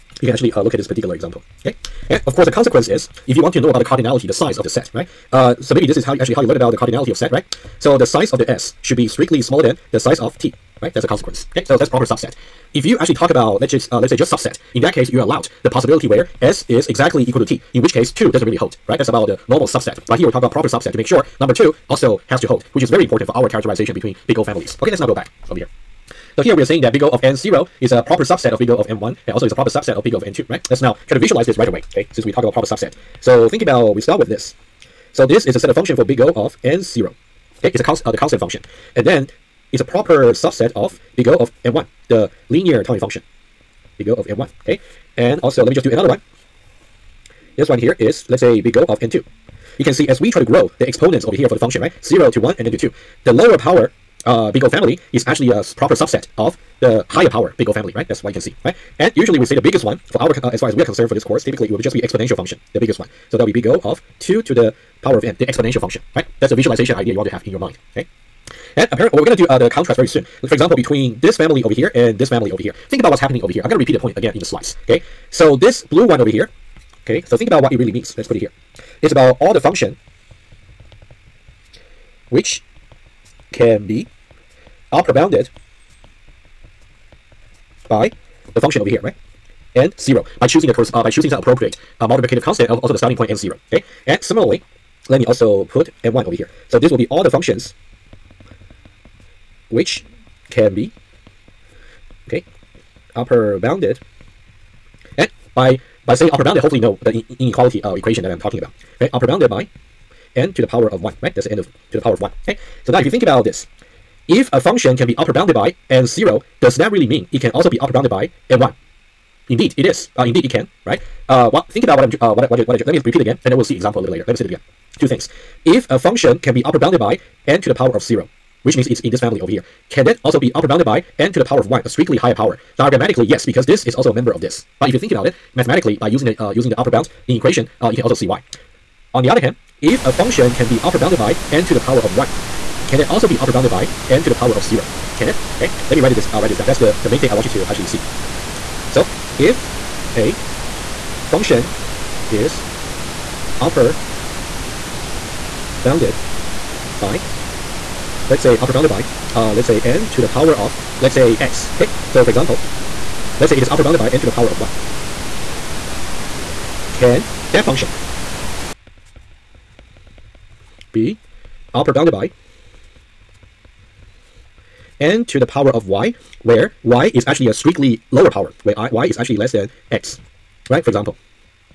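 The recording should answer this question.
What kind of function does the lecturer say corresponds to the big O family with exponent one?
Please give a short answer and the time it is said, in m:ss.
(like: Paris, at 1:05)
Linear time function, at 0:42.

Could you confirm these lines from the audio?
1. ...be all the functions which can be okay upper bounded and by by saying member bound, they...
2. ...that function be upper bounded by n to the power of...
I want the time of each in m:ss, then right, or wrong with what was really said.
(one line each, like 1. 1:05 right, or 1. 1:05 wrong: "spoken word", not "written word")
1. 1:36 wrong: "upper", not "member"
2. 2:47 right.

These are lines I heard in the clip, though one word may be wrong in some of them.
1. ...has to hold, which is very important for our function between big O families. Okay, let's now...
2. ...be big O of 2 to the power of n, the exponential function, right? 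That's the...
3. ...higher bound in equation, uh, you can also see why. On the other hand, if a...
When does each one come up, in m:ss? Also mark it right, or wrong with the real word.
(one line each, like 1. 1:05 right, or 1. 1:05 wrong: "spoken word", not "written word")
1. 0:22 wrong: "characterization", not "function"
2. 1:03 right
3. 2:16 wrong: "upper", not "higher".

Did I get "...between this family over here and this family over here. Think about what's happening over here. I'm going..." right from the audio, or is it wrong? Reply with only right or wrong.
right.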